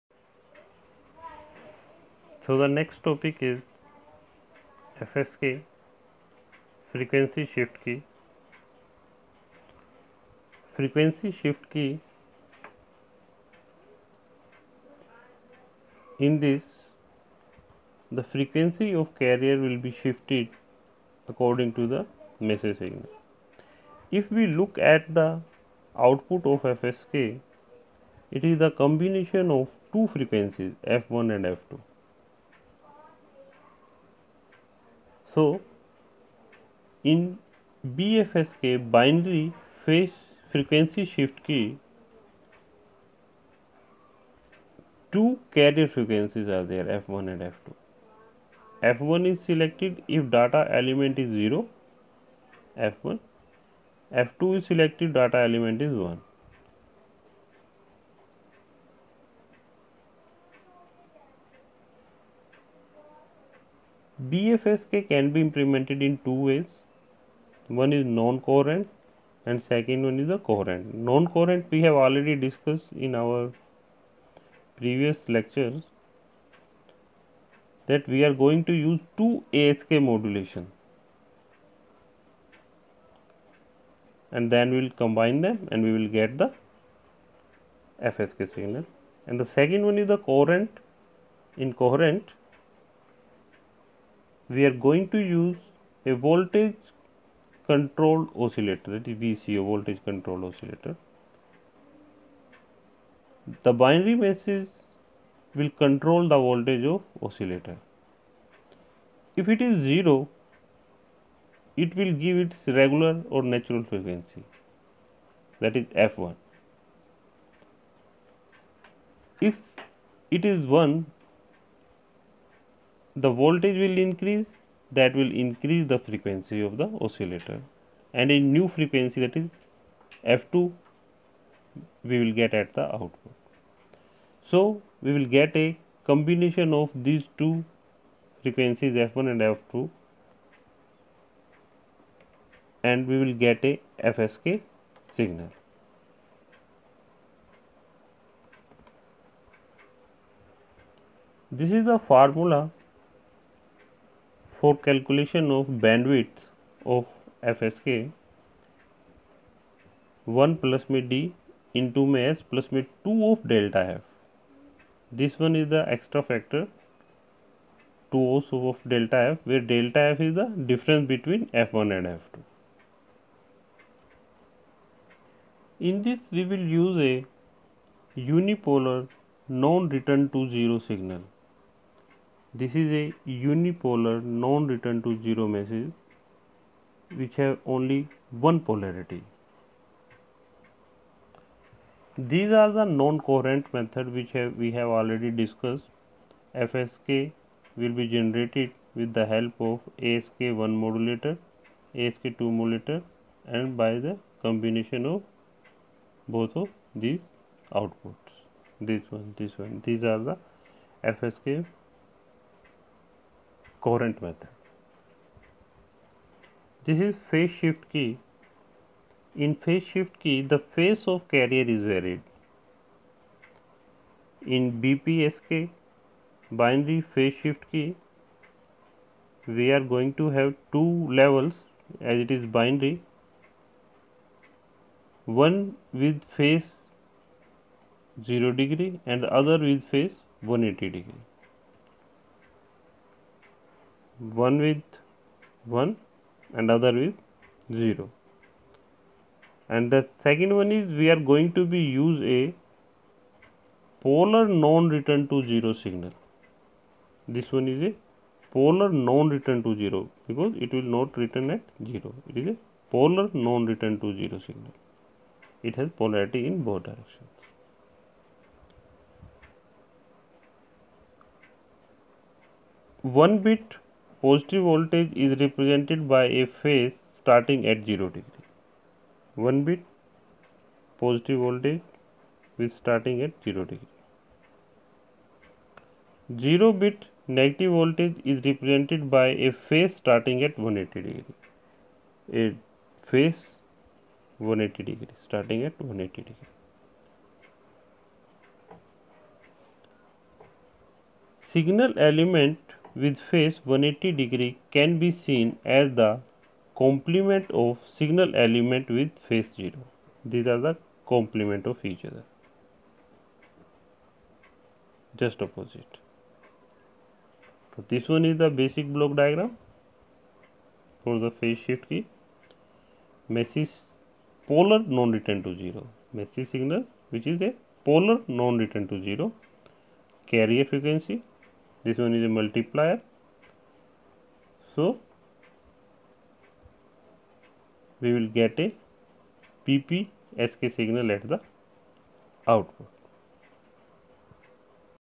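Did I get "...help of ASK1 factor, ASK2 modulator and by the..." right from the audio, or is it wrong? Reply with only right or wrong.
wrong.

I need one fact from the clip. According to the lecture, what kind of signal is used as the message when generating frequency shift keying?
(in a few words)
unipolar non-return to zero.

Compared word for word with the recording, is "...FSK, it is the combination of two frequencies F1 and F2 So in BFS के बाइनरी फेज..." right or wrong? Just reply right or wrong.
right.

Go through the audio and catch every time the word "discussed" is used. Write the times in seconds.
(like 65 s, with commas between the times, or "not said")
72 s, 195 s.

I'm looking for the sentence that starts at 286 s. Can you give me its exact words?
0 bit negative voltage is represented by a phase starting at 180 degree.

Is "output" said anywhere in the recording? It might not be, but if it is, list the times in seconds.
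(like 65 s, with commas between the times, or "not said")
26 s, 132 s, 207 s, 342 s.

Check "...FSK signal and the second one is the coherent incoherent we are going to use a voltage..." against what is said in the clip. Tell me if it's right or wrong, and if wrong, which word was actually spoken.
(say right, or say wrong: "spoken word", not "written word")
right.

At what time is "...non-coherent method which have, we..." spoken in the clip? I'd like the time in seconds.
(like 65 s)
192 s.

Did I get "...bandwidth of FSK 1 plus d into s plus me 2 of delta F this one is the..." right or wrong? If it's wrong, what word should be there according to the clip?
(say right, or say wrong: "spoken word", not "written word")
right.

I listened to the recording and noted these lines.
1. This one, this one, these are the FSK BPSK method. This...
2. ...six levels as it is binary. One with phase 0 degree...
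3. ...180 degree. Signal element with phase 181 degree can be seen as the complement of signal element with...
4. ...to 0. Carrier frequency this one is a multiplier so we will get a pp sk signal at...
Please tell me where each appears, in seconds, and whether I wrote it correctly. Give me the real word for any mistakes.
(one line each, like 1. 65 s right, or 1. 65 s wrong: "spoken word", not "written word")
1. 208 s wrong: "Coherent", not "BPSK"
2. 230 s wrong: "two", not "six"
3. 295 s wrong: "180", not "181"
4. 328 s right.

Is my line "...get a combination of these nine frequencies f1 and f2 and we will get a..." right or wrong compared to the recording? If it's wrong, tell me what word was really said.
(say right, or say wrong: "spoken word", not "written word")
wrong: "two", not "nine".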